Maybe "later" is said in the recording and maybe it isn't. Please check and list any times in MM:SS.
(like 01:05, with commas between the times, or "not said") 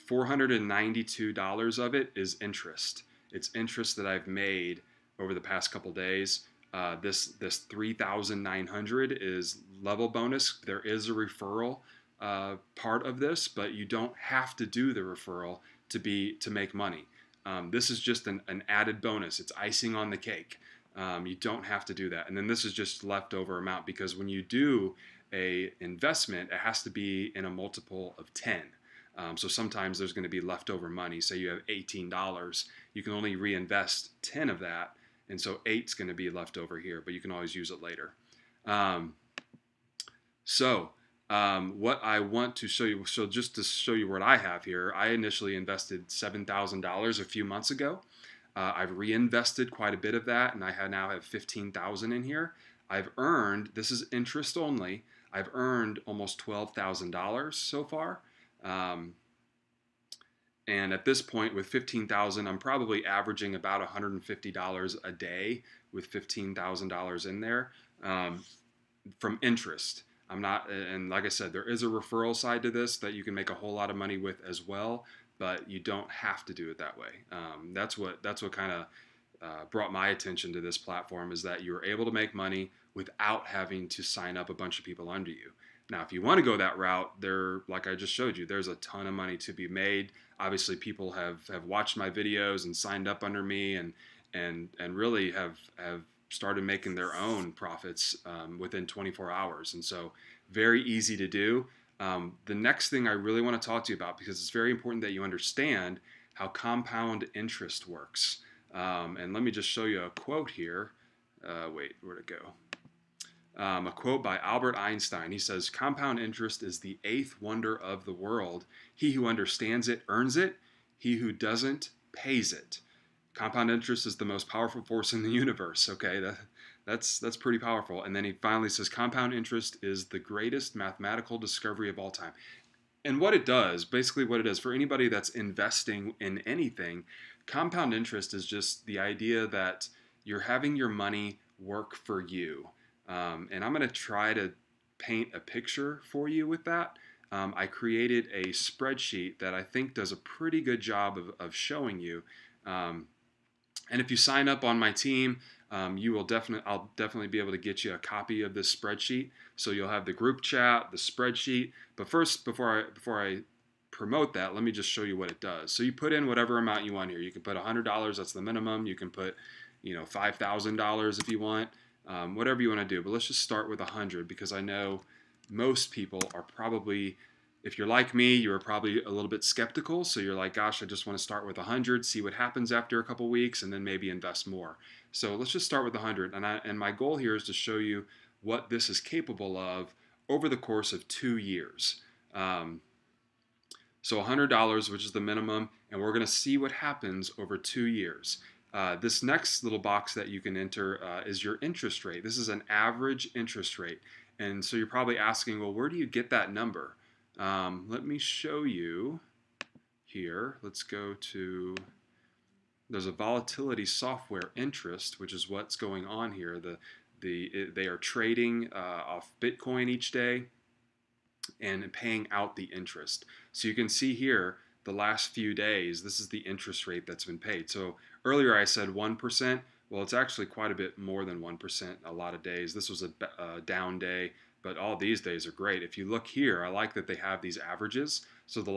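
00:37.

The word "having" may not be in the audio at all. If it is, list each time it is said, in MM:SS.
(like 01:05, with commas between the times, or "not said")
01:23, 02:20.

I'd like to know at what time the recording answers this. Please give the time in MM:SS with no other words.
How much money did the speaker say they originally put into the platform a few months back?
00:46.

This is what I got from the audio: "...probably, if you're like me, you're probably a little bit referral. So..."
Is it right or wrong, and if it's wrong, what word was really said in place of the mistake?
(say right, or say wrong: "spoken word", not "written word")
wrong: "skeptical", not "referral".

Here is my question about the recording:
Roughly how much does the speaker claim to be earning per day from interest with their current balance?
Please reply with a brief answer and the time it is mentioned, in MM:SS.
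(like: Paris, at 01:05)
$150, at 01:03.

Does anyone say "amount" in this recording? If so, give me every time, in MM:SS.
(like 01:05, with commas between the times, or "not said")
00:23, 02:46.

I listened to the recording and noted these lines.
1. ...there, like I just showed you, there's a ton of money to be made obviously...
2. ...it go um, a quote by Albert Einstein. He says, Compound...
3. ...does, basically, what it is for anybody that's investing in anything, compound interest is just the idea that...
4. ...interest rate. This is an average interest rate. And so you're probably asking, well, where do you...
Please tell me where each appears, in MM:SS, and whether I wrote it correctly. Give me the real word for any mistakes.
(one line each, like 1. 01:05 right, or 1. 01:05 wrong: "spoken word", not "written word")
1. 01:27 right
2. 01:52 right
3. 02:13 right
4. 03:21 right.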